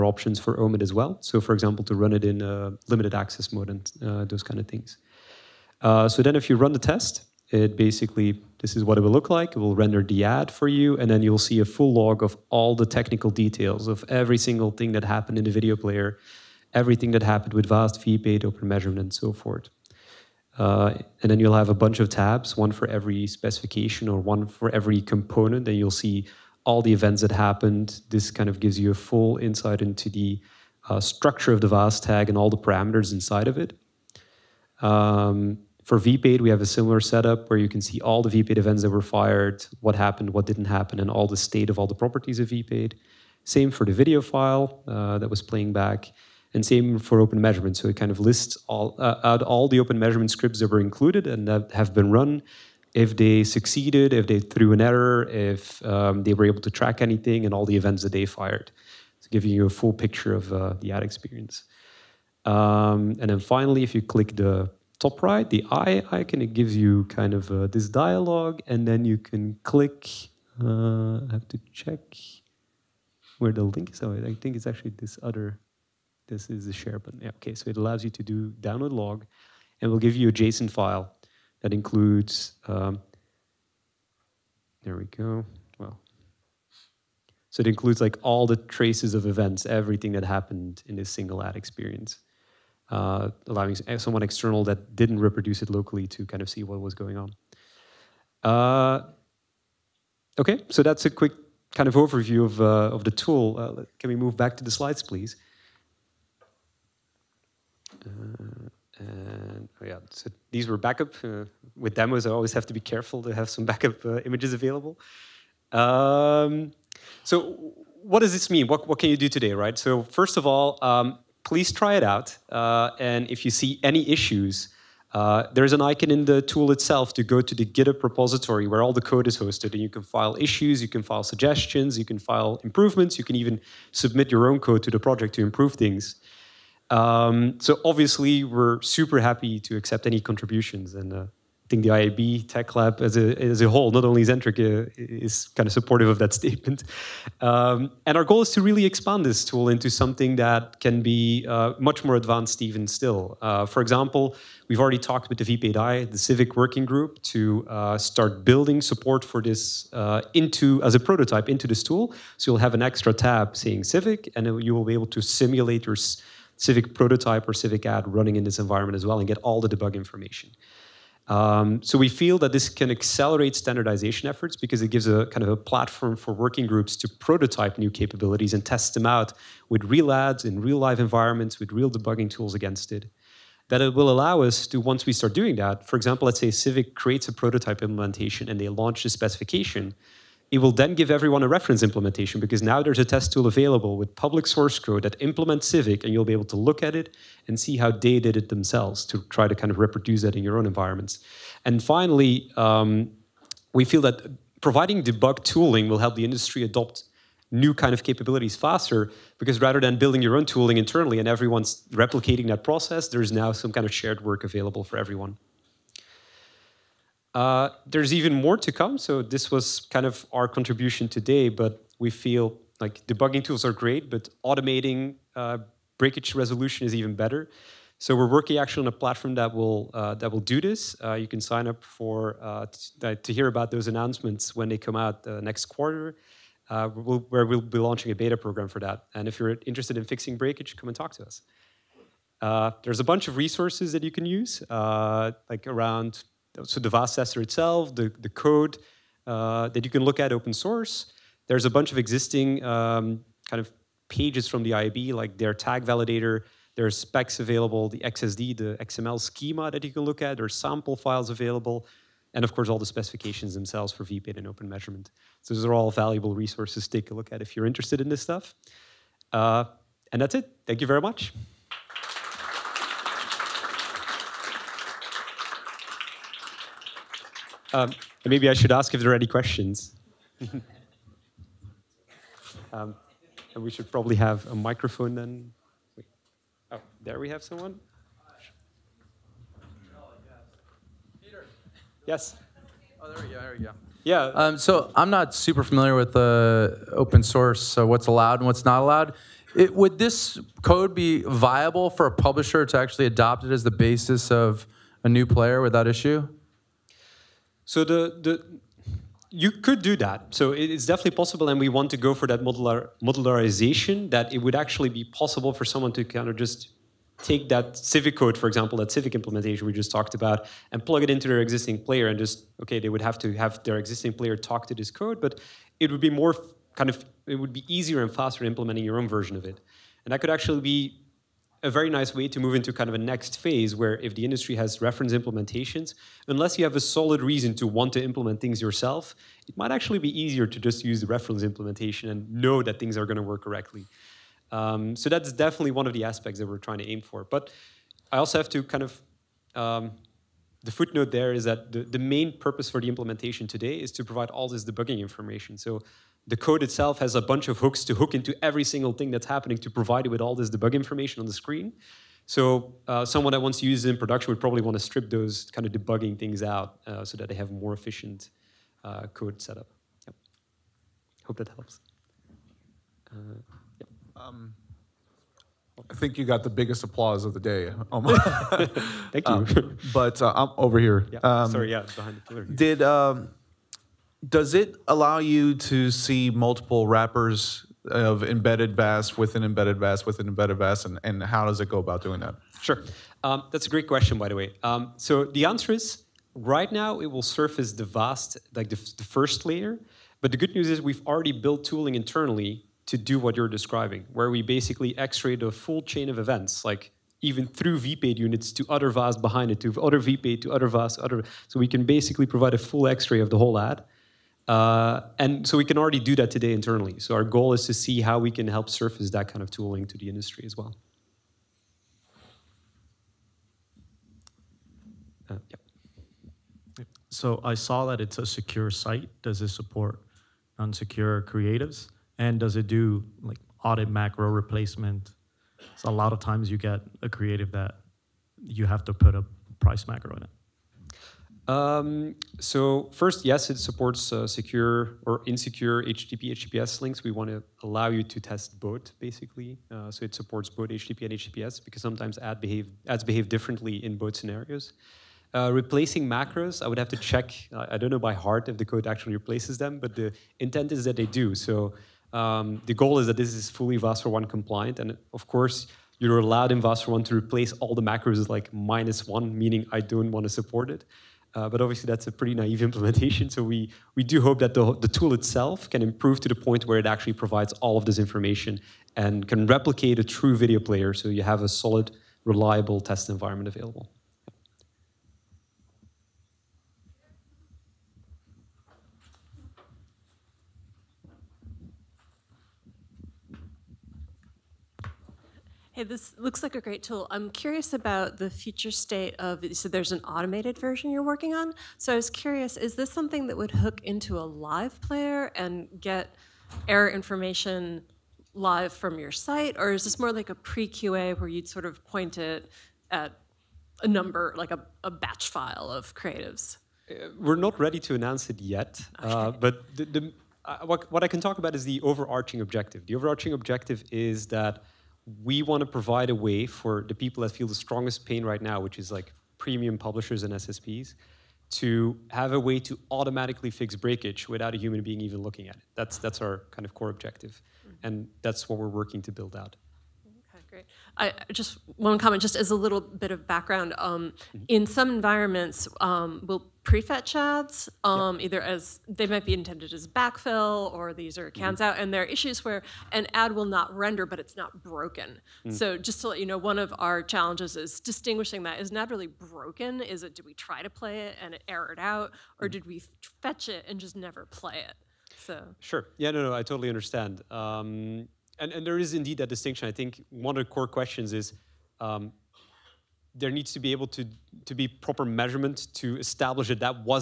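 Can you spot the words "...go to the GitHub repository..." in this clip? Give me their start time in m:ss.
2:07.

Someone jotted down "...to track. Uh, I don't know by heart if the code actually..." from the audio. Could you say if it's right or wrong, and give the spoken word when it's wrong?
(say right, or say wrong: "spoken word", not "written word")
wrong: "check", not "track".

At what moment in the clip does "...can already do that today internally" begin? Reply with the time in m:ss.
6:55.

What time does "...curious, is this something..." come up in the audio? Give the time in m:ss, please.
8:22.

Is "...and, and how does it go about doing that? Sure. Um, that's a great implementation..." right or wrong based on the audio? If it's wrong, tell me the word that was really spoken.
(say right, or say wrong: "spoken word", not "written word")
wrong: "question", not "implementation".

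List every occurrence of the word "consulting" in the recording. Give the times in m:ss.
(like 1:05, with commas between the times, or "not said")
not said.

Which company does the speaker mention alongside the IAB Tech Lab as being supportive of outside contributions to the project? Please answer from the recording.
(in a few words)
Zentrick.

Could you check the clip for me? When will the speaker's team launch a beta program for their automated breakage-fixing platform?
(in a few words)
next quarter.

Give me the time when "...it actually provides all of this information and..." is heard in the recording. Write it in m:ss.
7:56.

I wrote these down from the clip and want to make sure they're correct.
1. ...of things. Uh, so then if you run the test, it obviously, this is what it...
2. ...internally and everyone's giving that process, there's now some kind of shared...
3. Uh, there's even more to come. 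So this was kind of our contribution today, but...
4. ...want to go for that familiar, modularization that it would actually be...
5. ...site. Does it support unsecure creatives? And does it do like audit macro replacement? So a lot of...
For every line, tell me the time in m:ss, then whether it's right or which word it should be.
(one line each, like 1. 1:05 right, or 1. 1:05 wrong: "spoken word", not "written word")
1. 0:04 wrong: "basically", not "obviously"
2. 3:30 wrong: "replicating", not "giving"
3. 3:37 right
4. 5:11 wrong: "modular", not "familiar"
5. 7:08 right.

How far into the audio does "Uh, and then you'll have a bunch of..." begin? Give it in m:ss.
0:20.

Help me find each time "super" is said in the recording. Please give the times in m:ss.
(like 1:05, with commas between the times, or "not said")
2:18, 4:55.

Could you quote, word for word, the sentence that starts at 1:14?
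Oh, I think it's actually this other.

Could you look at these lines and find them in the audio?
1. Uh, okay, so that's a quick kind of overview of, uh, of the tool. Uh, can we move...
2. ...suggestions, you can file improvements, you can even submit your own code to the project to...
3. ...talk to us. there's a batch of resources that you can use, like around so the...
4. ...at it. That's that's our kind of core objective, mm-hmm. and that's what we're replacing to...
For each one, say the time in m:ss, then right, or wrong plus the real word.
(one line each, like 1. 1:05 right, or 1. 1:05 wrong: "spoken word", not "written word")
1. 1:38 right
2. 2:11 right
3. 4:00 wrong: "bunch", not "batch"
4. 8:55 wrong: "working", not "replacing".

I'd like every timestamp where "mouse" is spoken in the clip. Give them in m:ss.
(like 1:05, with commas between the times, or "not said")
not said.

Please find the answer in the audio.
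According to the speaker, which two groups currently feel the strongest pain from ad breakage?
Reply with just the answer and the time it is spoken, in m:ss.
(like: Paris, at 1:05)
premium publishers and SSPs, at 8:49.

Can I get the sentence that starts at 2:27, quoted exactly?
Um, and our goal is to really expand this tool into something that can be uh, much more advanced even still.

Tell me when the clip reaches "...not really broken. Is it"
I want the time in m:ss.
9:18.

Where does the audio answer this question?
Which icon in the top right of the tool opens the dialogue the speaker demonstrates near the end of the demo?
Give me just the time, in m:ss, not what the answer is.
1:05.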